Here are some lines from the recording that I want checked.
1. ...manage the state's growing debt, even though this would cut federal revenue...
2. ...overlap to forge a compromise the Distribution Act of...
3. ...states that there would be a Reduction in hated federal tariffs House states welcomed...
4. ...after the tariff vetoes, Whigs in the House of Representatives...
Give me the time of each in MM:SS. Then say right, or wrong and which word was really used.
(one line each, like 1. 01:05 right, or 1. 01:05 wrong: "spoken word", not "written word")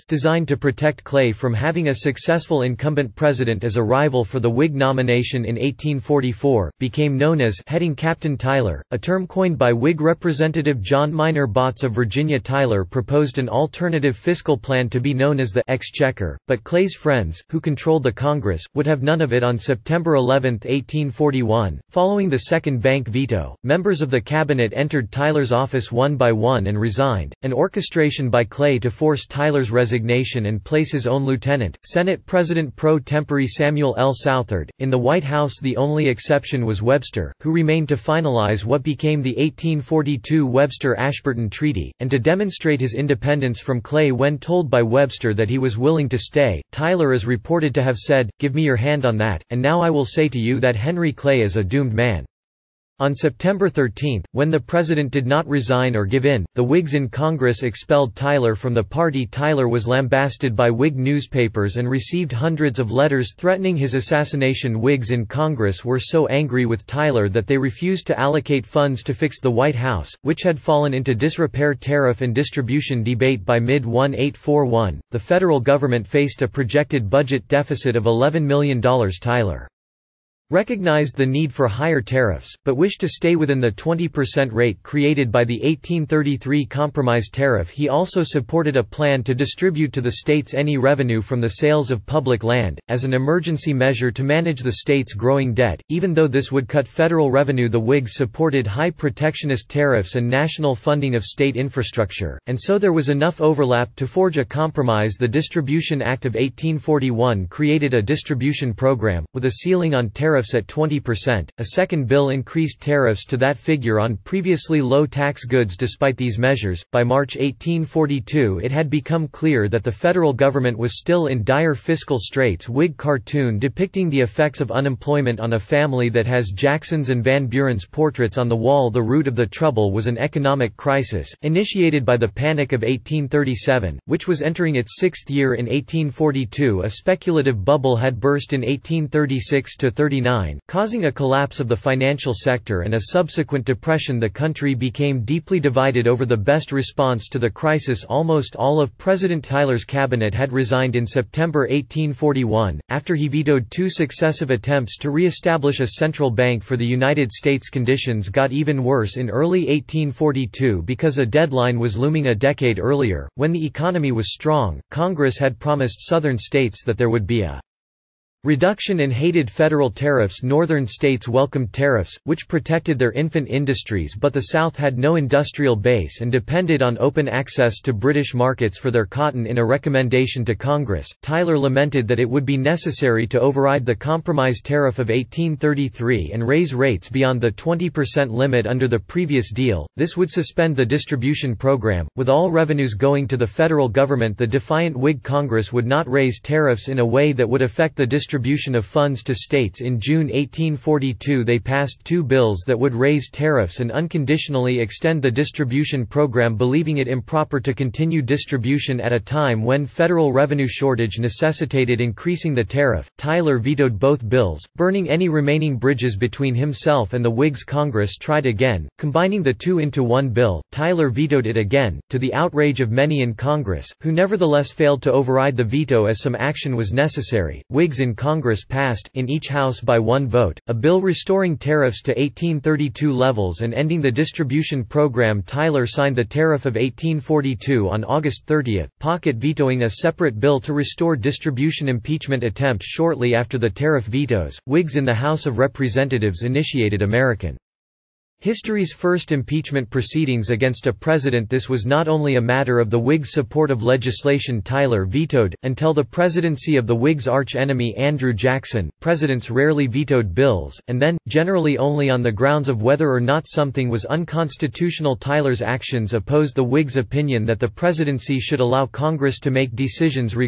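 1. 01:34 right
2. 01:43 right
3. 02:46 wrong: "Northern", not "House"
4. 04:03 right.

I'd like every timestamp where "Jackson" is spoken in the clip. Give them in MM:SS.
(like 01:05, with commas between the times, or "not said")
02:06, 04:18.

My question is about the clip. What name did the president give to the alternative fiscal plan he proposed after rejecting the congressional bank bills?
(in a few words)
the Exchequer.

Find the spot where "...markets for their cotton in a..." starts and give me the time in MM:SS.
02:58.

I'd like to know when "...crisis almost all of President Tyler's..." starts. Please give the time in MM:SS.
02:27.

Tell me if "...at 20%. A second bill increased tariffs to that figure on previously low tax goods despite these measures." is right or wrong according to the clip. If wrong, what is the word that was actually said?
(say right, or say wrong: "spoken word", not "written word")
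right.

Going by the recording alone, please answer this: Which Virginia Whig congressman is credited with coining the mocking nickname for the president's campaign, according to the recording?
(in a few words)
John Minor Botts.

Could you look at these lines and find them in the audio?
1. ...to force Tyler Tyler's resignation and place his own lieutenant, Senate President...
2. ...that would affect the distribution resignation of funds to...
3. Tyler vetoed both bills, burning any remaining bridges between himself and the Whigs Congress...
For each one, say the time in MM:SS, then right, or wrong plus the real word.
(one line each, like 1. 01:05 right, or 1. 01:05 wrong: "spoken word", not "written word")
1. 00:28 right
2. 03:17 wrong: "distribution", not "resignation"
3. 03:33 right.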